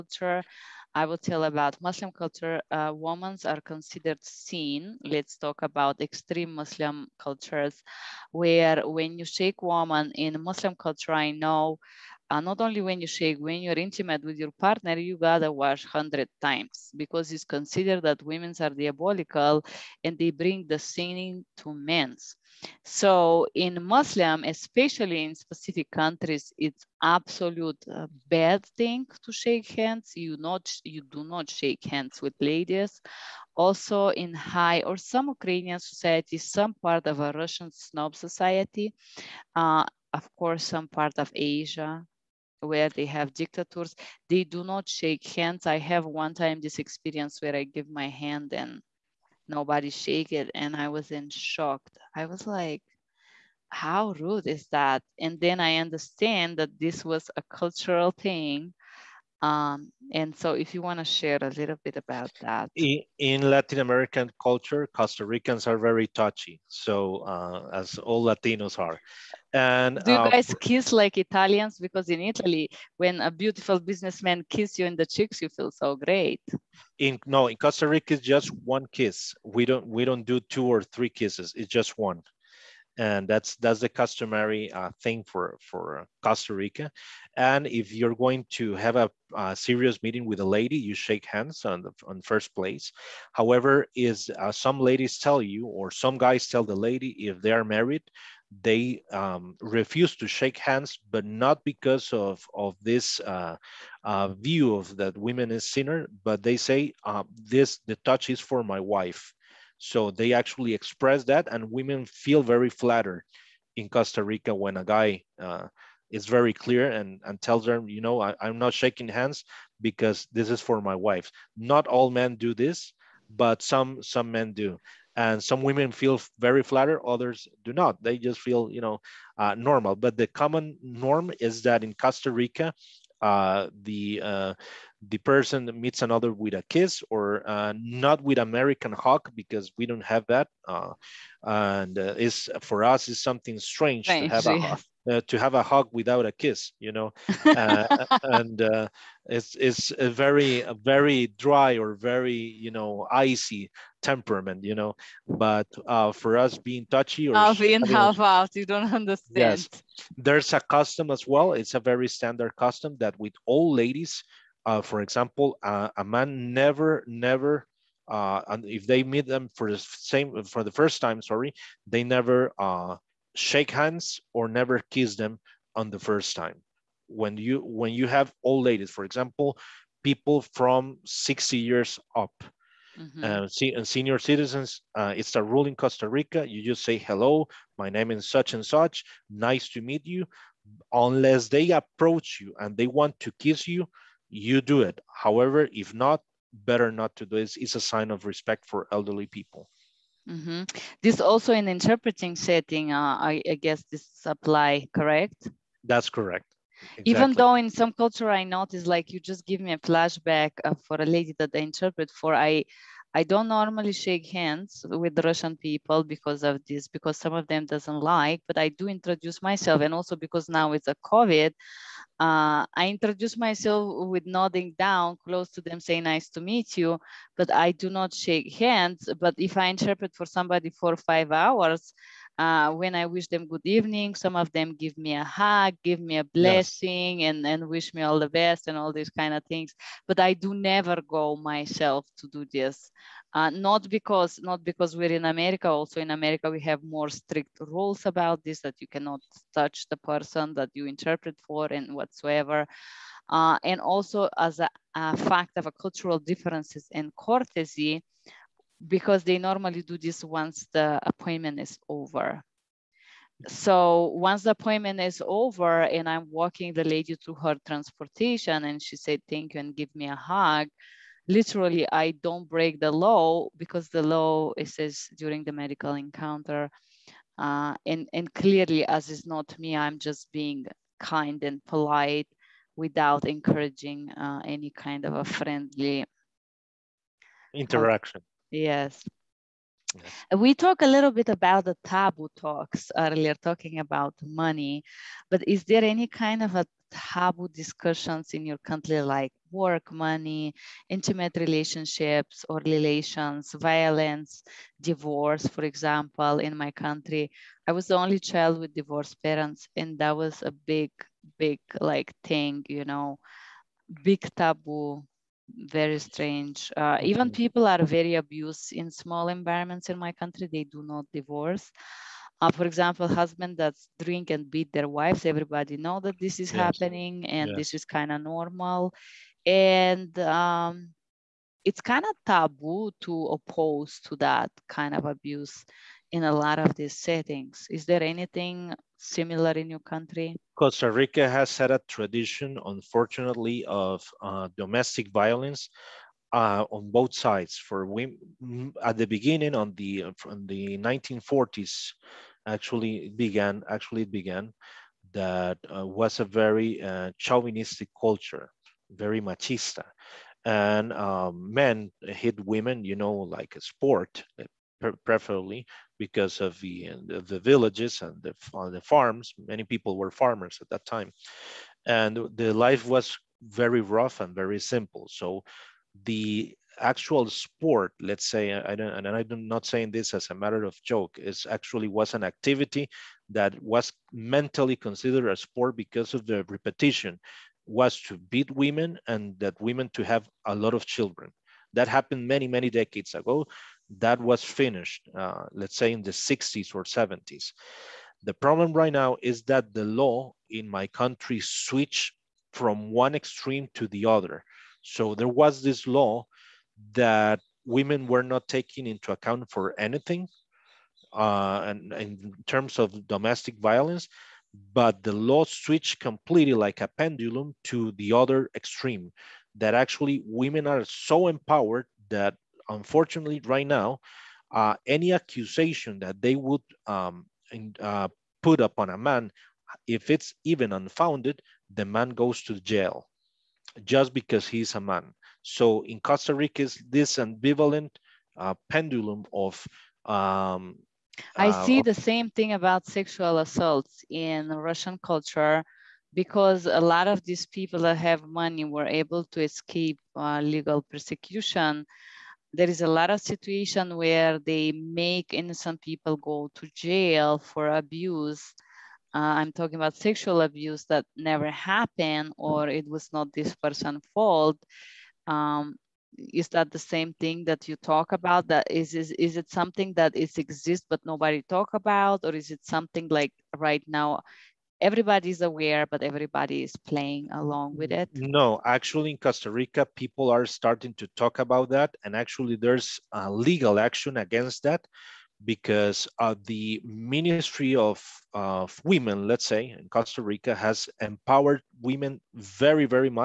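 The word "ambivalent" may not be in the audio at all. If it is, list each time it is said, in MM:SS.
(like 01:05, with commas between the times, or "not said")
07:17.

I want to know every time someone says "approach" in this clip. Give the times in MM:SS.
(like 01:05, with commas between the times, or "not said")
03:11.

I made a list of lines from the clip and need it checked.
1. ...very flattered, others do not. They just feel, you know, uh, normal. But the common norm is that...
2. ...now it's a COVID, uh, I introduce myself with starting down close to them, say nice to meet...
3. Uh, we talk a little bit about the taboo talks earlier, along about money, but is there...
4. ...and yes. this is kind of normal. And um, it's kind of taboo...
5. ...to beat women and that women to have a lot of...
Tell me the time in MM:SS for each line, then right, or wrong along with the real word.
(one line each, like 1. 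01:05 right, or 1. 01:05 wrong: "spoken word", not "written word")
1. 02:06 right
2. 03:40 wrong: "nodding", not "starting"
3. 04:50 wrong: "talking", not "along"
4. 05:27 right
5. 06:28 right.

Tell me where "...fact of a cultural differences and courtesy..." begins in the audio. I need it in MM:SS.
04:15.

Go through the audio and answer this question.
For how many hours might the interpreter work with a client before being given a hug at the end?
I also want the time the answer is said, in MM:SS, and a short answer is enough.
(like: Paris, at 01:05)
5, at 03:50.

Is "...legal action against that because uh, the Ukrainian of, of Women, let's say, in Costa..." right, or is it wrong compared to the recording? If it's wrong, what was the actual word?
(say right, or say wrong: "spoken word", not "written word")
wrong: "Ministry", not "Ukrainian".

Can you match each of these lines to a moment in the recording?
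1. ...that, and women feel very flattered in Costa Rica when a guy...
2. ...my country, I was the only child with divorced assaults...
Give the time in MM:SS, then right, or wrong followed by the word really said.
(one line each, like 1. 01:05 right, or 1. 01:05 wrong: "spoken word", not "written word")
1. 01:51 right
2. 05:06 wrong: "parents", not "assaults".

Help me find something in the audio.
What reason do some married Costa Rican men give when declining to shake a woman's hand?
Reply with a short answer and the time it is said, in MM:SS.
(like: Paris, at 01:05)
the touch is for my wife, at 01:47.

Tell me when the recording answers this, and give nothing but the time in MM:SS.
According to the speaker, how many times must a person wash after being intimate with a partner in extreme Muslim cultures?
00:15.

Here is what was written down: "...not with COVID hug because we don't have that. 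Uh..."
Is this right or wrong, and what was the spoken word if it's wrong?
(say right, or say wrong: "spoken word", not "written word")
wrong: "American", not "COVID".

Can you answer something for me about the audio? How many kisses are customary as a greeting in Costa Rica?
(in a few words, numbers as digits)
1.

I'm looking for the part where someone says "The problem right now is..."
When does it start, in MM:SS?
06:38.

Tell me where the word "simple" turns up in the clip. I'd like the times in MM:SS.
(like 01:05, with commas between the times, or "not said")
06:14.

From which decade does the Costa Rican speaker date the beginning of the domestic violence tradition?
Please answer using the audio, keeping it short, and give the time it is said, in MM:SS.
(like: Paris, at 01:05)
1940s, at 05:50.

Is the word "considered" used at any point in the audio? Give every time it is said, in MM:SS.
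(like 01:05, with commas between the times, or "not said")
00:03, 00:17, 06:24.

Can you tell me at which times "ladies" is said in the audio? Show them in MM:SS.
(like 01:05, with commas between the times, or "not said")
00:32, 01:34, 02:43, 02:58.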